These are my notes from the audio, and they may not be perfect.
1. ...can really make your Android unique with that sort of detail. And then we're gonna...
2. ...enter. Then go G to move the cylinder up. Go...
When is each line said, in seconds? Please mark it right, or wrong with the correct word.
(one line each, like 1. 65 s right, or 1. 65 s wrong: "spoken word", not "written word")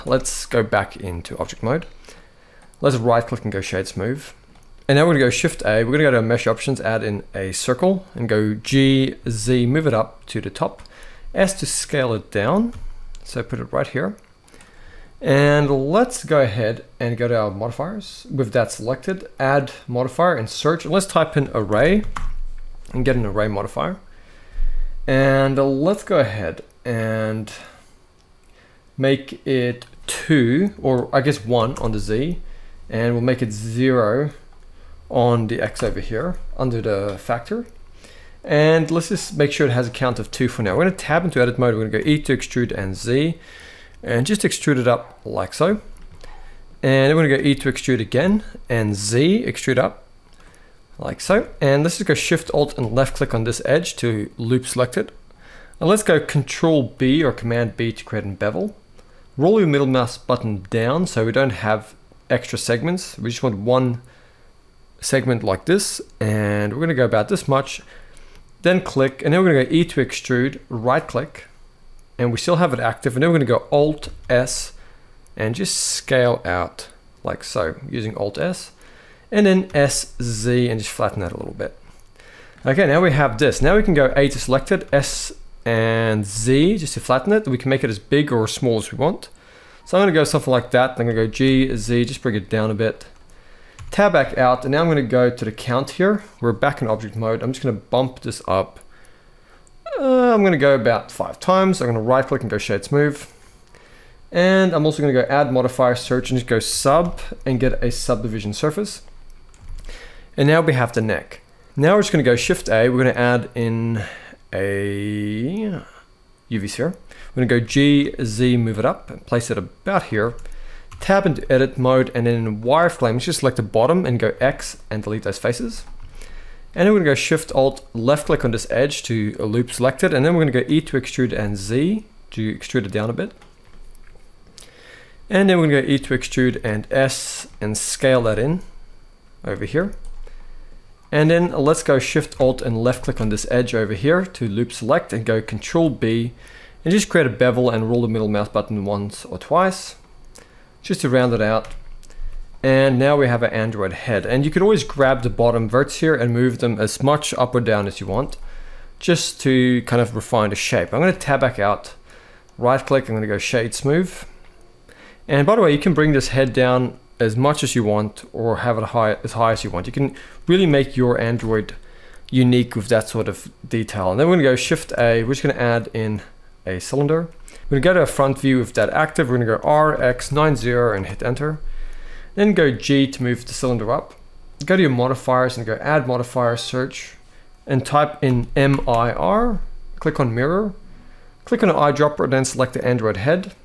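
1. 169 s right
2. 181 s right.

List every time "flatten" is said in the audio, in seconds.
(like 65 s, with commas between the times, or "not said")
80 s, 87 s.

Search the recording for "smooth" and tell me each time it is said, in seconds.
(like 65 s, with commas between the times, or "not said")
3 s, 102 s, 163 s.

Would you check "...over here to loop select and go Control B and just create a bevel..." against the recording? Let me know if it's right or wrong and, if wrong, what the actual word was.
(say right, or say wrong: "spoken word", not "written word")
right.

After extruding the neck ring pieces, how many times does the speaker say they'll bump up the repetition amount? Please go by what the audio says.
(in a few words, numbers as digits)
5.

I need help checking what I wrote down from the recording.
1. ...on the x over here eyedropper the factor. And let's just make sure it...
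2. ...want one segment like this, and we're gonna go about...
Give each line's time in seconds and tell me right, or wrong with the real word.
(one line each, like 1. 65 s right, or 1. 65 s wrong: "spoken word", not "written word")
1. 35 s wrong: "under", not "eyedropper"
2. 63 s right.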